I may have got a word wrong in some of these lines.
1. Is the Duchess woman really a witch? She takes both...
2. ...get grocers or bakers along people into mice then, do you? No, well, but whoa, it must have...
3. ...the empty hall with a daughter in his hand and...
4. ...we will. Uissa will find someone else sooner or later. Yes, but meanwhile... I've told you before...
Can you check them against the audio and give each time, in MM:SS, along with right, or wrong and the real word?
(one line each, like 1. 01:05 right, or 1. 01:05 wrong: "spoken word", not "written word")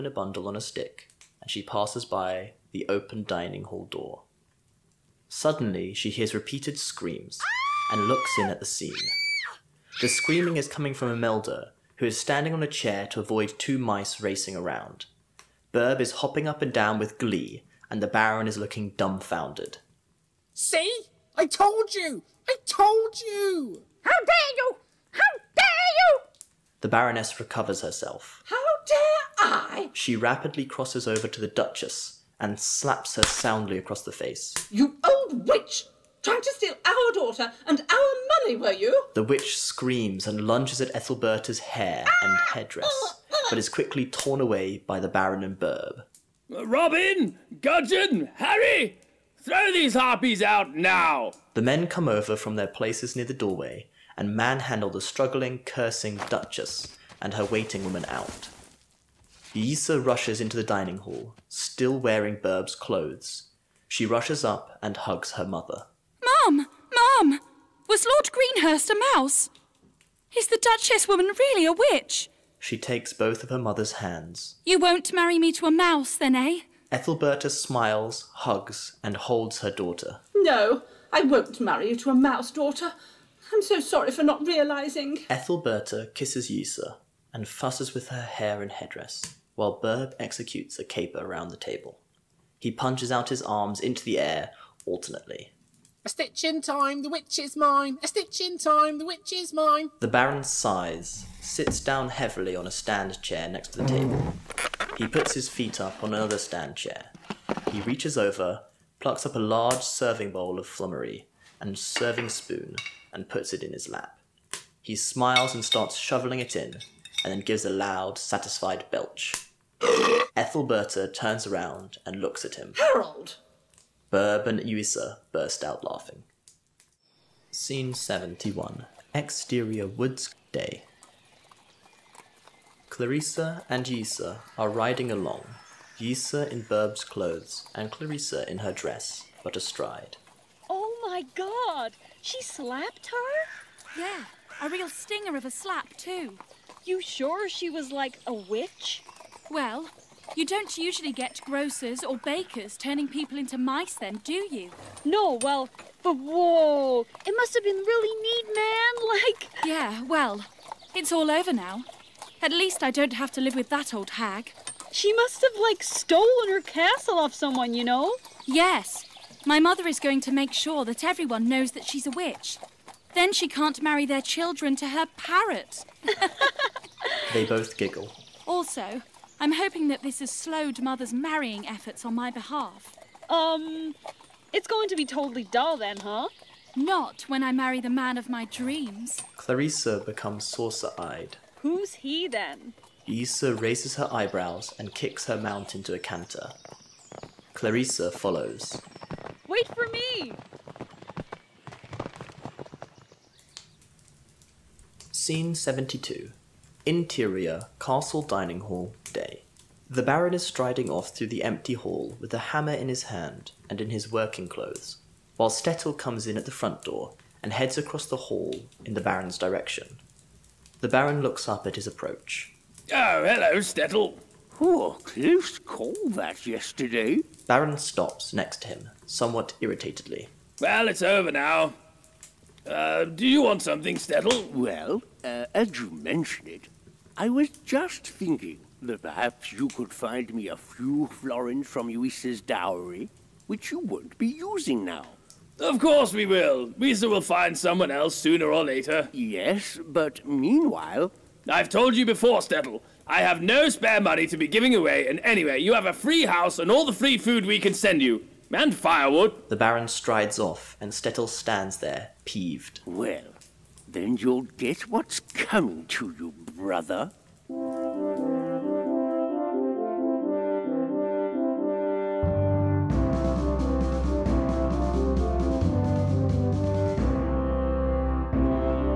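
1. 01:10 right
2. 02:31 wrong: "turning", not "along"
3. 03:31 wrong: "hammer", not "daughter"
4. 04:06 right.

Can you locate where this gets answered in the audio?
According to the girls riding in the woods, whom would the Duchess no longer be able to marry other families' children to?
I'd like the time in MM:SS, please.
02:54.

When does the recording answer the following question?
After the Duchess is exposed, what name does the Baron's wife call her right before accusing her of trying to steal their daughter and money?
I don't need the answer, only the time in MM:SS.
00:34.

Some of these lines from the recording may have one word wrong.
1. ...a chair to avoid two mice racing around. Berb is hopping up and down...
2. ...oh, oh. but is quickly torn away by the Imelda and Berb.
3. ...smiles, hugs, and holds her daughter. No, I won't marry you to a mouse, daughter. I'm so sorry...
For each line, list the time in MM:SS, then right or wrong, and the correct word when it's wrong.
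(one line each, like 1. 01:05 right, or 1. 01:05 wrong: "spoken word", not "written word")
1. 00:12 right
2. 00:43 wrong: "Baron", not "Imelda"
3. 01:17 right.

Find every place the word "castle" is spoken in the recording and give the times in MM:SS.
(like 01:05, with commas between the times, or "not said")
02:46, 03:27.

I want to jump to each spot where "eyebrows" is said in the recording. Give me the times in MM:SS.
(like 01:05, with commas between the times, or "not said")
03:14.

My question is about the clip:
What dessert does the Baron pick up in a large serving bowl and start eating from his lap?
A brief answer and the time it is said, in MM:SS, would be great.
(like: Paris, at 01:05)
flummery, at 01:50.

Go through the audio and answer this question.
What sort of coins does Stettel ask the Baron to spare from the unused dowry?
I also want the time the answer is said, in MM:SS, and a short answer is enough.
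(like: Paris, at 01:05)
florins, at 04:01.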